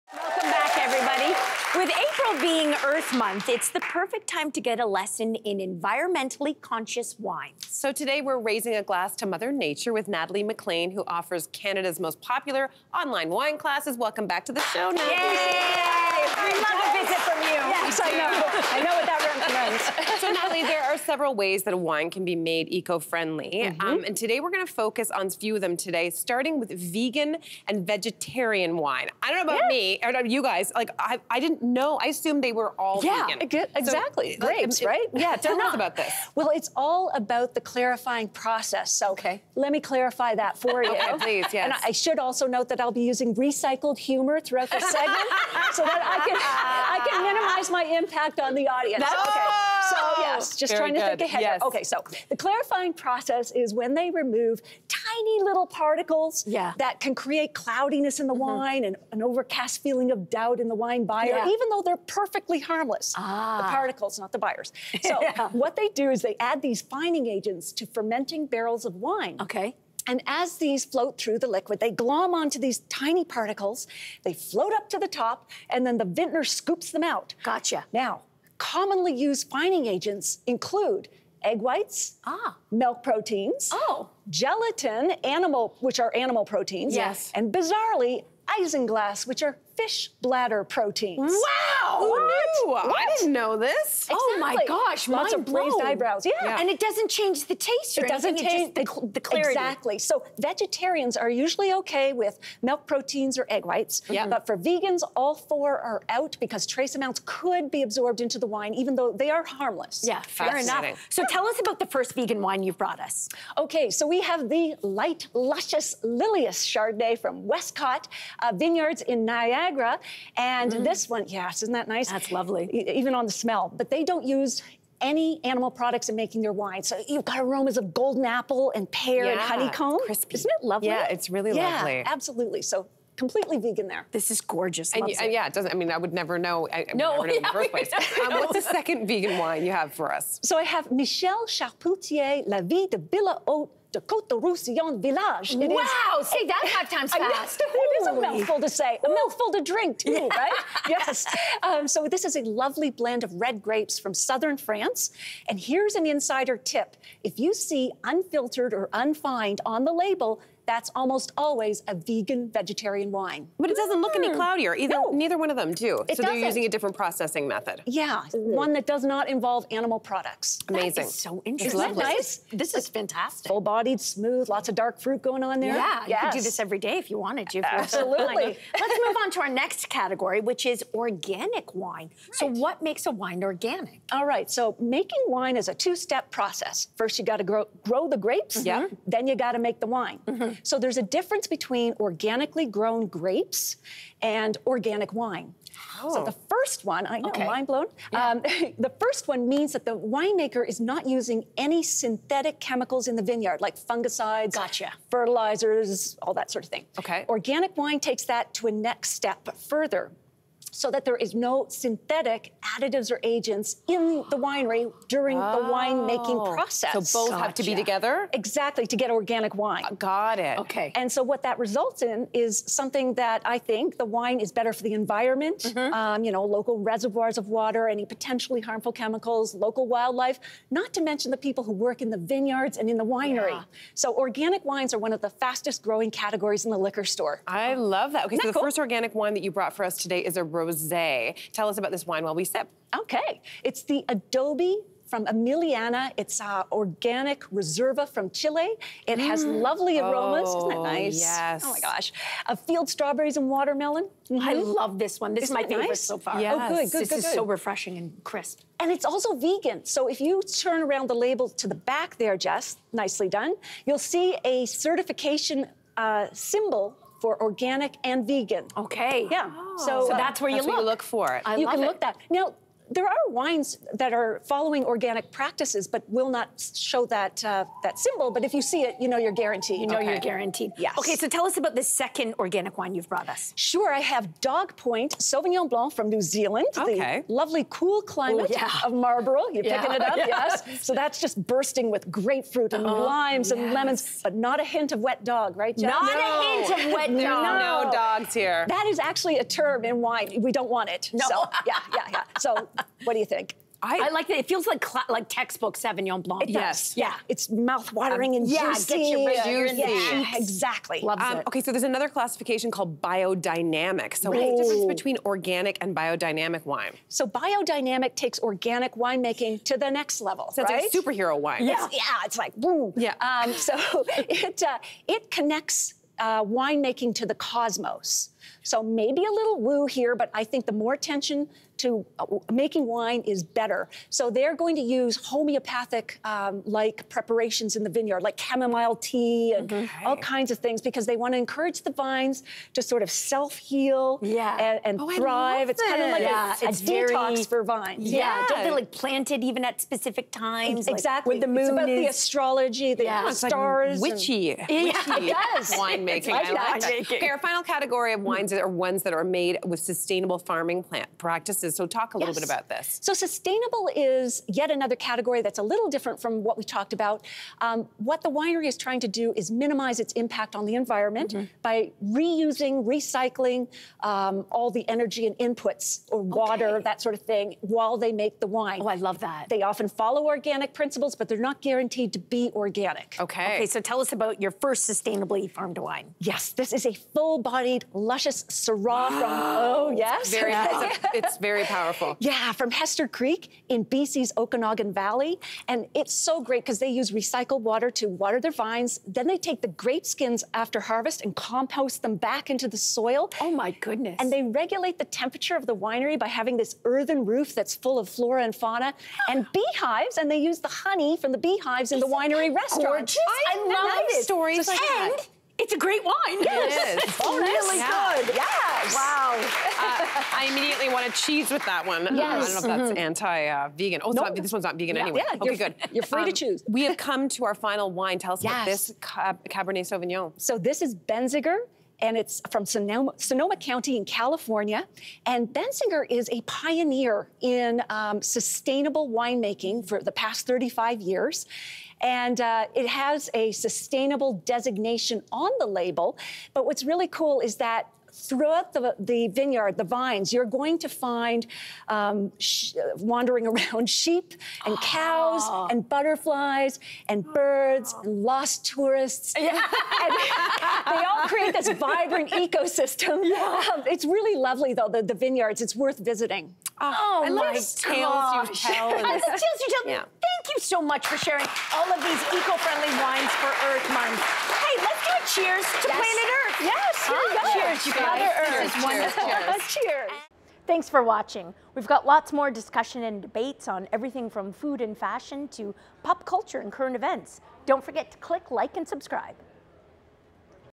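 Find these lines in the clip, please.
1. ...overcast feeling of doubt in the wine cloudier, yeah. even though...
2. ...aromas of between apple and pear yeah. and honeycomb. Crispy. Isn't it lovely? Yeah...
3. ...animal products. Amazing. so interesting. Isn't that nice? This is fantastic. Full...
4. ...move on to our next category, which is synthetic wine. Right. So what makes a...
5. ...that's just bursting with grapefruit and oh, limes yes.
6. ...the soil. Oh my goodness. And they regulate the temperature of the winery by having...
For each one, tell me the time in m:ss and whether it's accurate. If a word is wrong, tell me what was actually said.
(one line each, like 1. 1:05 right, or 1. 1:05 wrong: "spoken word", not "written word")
1. 0:59 wrong: "buyer", not "cloudier"
2. 2:07 wrong: "golden", not "between"
3. 2:49 right
4. 2:59 wrong: "organic", not "synthetic"
5. 4:50 right
6. 6:42 right.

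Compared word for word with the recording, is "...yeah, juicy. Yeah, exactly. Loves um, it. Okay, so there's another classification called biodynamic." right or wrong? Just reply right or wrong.
right.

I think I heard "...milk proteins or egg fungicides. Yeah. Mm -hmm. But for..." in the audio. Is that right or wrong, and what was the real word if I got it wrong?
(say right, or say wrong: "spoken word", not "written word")
wrong: "whites", not "fungicides".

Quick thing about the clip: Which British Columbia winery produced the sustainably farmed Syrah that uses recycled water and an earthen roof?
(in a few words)
Hester Creek.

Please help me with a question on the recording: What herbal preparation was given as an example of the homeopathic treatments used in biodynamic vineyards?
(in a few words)
Chamomile tea.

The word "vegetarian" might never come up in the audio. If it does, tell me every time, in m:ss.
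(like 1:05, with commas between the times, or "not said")
0:27, 1:40, 2:42.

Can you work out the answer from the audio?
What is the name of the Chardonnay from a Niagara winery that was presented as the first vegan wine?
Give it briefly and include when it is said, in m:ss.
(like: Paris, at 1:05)
Lillias, at 1:56.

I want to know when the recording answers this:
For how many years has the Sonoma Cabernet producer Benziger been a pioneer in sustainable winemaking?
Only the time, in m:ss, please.
7:20.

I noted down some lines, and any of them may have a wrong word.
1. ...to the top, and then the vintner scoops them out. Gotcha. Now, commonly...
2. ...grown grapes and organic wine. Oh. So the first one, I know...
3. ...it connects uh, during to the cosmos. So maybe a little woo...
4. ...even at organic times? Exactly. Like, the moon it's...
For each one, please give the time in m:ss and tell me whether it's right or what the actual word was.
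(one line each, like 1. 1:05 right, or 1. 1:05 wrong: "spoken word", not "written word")
1. 1:14 right
2. 3:12 right
3. 5:25 wrong: "winemaking", not "during"
4. 5:49 wrong: "specific", not "organic".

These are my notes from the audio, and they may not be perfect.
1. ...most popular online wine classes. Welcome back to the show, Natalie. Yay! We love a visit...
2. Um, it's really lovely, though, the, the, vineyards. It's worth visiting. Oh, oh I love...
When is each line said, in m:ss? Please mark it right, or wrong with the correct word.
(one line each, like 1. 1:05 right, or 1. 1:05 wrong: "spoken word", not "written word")
1. 0:11 right
2. 7:43 right.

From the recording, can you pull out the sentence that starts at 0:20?
so, Natalie, there are several ways that a wine can be made eco-friendly.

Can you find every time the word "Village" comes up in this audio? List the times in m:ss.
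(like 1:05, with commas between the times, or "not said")
2:25.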